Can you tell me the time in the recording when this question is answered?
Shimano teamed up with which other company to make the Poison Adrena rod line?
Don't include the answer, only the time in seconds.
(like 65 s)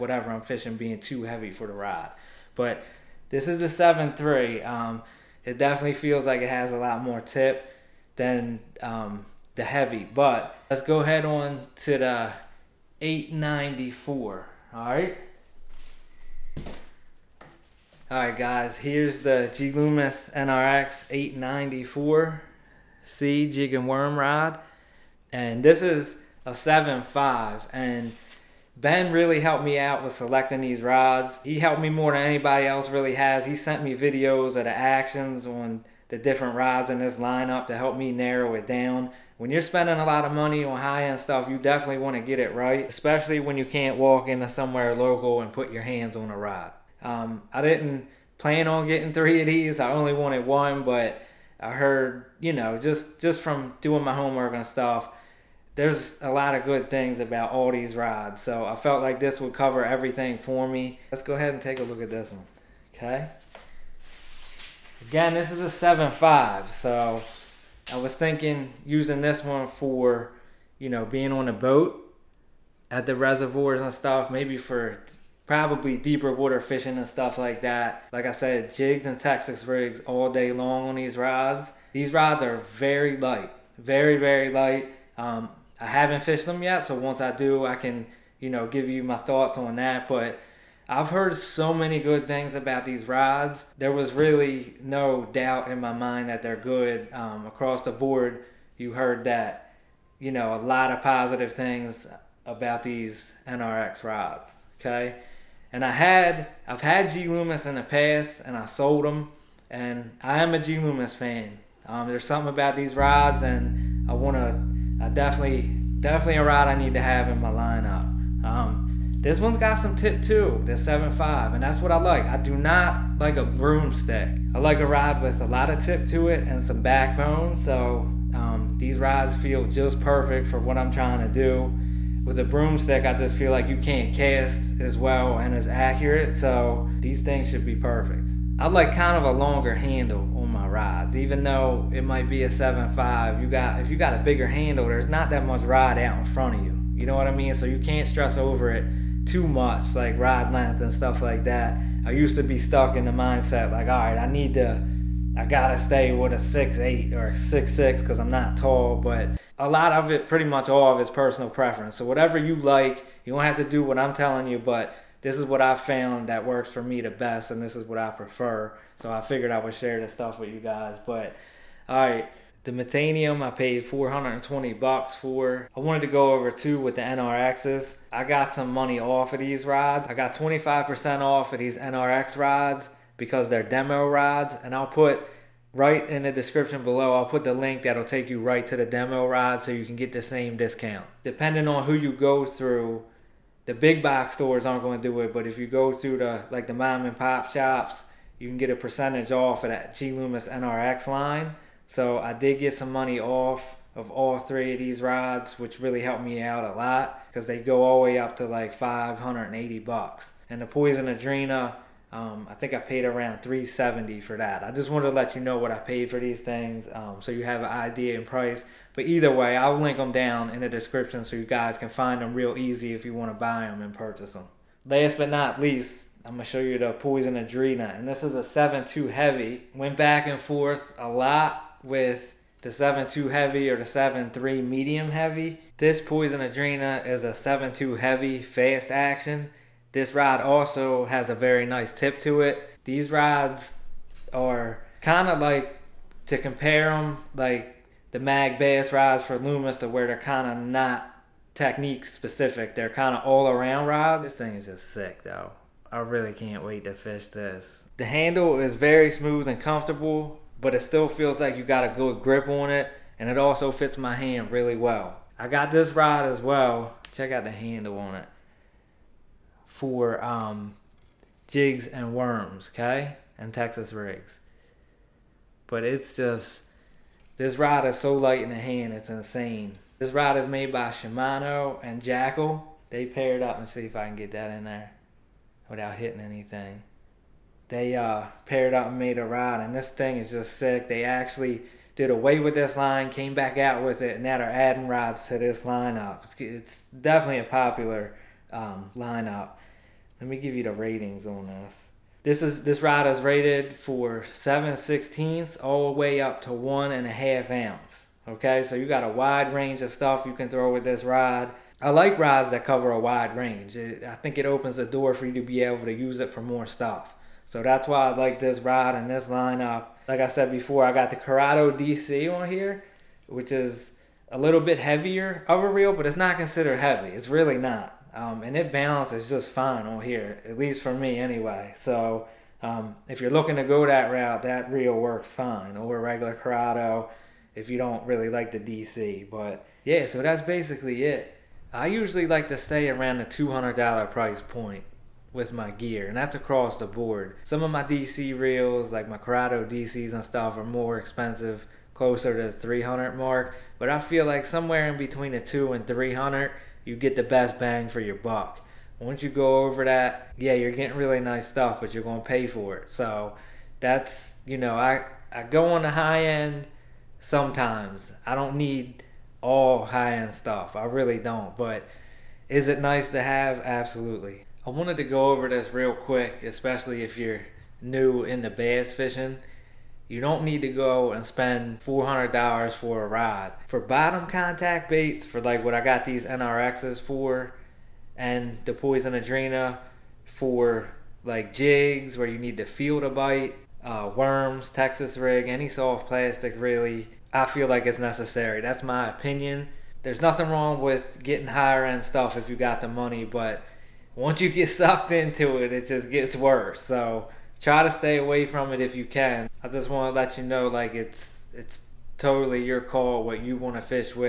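282 s.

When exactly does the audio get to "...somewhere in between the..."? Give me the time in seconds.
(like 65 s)
354 s.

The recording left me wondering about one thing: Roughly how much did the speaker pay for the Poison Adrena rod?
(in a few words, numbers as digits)
$370.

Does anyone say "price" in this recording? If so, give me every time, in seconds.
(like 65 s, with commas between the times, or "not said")
218 s, 344 s.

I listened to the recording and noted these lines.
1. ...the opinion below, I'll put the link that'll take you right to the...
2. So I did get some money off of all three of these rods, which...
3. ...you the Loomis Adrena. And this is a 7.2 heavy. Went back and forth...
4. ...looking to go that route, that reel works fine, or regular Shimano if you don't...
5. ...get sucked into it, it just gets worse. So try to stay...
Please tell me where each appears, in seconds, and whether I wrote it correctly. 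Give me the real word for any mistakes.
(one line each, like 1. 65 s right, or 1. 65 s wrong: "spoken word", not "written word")
1. 186 s wrong: "description", not "opinion"
2. 201 s right
3. 226 s wrong: "Poison", not "Loomis"
4. 333 s wrong: "Corrado", not "Shimano"
5. 404 s right.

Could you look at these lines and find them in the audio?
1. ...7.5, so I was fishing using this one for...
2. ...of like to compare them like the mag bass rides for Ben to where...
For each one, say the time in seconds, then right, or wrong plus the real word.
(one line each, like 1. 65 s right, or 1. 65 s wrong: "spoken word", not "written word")
1. 65 s wrong: "thinking", not "fishing"
2. 245 s wrong: "Loomis", not "Ben".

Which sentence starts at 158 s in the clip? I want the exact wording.
But a lot of it, pretty much all of, it, is personal preference.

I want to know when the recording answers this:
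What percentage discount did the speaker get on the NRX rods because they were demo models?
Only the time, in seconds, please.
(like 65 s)
180 s.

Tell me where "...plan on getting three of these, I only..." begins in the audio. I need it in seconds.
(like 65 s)
48 s.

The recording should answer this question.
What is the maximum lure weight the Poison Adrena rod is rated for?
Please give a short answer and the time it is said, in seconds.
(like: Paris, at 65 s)
1.5 ounces, at 306 s.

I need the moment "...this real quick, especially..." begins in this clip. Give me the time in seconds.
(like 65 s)
375 s.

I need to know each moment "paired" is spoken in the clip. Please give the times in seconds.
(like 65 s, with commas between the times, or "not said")
283 s, 288 s.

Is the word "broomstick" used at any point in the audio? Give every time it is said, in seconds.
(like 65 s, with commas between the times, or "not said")
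123 s, 132 s.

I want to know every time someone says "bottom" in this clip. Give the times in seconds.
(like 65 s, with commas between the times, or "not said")
383 s.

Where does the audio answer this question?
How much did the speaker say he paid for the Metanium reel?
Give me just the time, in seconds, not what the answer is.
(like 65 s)
173 s.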